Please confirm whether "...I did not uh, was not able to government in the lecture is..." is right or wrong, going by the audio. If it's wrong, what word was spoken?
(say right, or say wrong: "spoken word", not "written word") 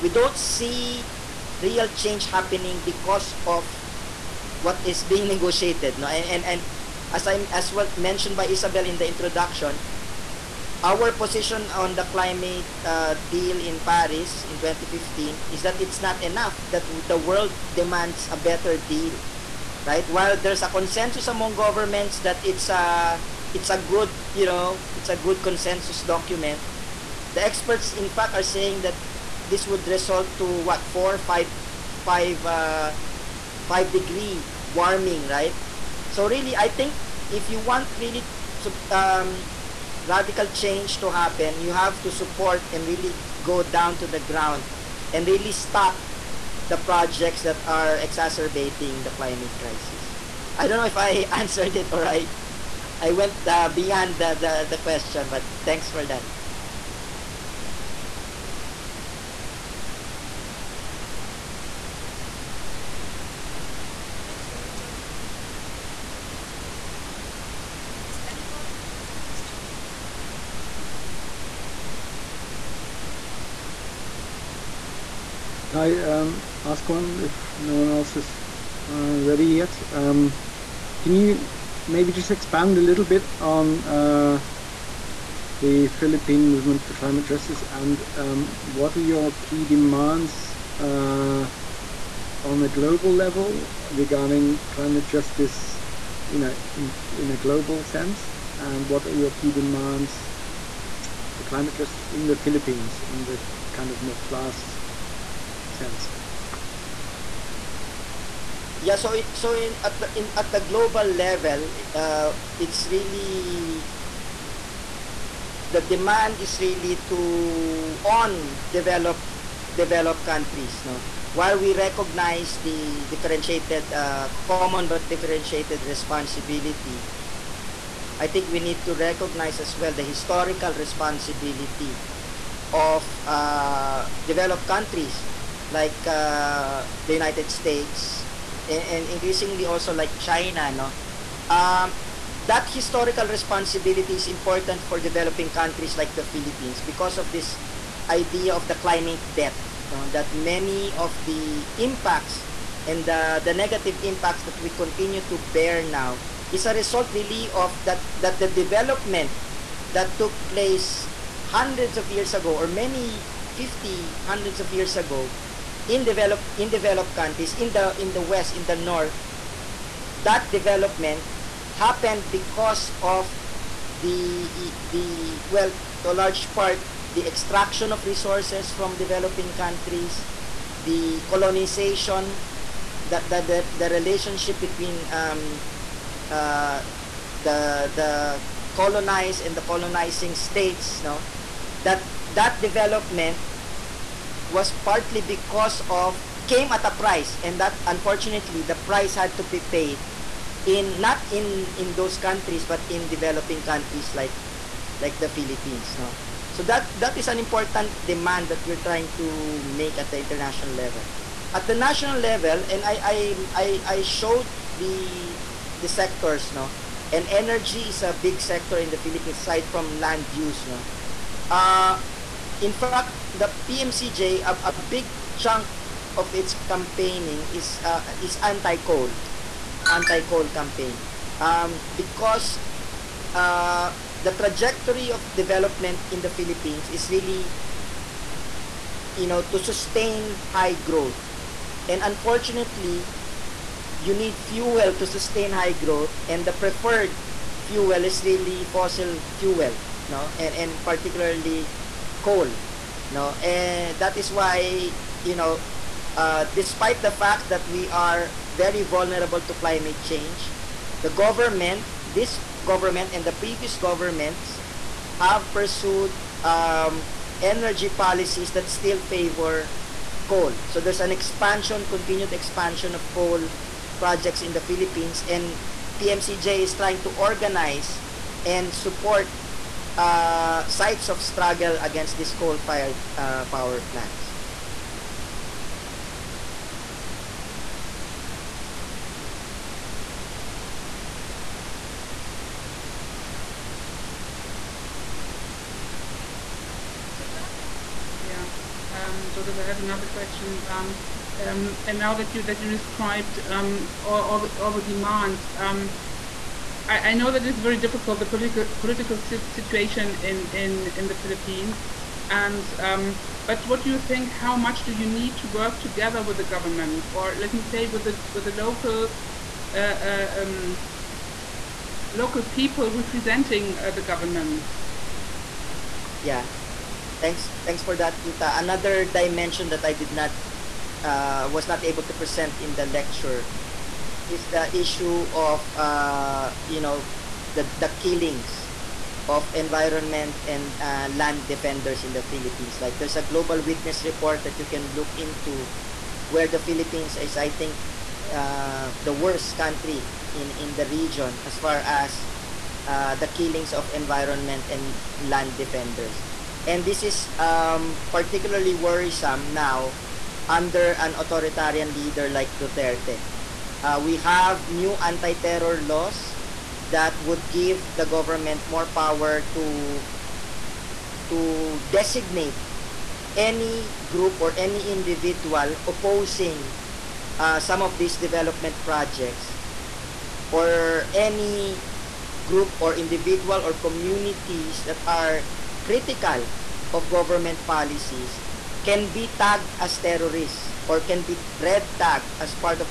wrong: "present", not "government".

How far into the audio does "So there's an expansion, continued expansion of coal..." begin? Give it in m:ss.
4:30.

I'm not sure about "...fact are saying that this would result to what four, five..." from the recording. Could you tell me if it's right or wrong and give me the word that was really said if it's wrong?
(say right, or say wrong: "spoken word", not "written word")
right.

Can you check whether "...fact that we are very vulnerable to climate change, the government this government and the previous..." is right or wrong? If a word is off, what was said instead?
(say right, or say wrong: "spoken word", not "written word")
right.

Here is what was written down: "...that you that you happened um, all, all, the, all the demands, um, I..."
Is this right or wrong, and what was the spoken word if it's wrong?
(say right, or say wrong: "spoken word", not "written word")
wrong: "described", not "happened".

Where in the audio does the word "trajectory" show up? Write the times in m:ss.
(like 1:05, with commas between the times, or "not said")
3:54.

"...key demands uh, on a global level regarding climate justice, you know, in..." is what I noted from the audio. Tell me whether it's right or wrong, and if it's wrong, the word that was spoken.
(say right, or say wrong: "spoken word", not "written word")
right.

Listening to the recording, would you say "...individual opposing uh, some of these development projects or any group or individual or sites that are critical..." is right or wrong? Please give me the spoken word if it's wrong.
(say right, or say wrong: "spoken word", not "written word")
wrong: "communities", not "sites".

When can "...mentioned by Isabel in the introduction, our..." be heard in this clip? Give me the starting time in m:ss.
0:07.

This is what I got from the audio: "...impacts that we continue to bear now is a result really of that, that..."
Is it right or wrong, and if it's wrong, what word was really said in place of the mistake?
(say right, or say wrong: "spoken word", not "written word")
right.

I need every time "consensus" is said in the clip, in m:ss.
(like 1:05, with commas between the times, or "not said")
0:20, 0:25.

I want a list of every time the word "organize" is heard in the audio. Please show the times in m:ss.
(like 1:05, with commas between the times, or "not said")
4:37.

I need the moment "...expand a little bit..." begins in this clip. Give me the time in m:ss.
1:22.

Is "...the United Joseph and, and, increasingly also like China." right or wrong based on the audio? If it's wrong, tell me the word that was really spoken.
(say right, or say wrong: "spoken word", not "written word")
wrong: "States", not "Joseph".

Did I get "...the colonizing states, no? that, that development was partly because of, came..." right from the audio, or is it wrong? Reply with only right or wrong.
right.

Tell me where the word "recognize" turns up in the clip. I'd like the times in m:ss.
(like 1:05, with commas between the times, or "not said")
2:01, 2:08.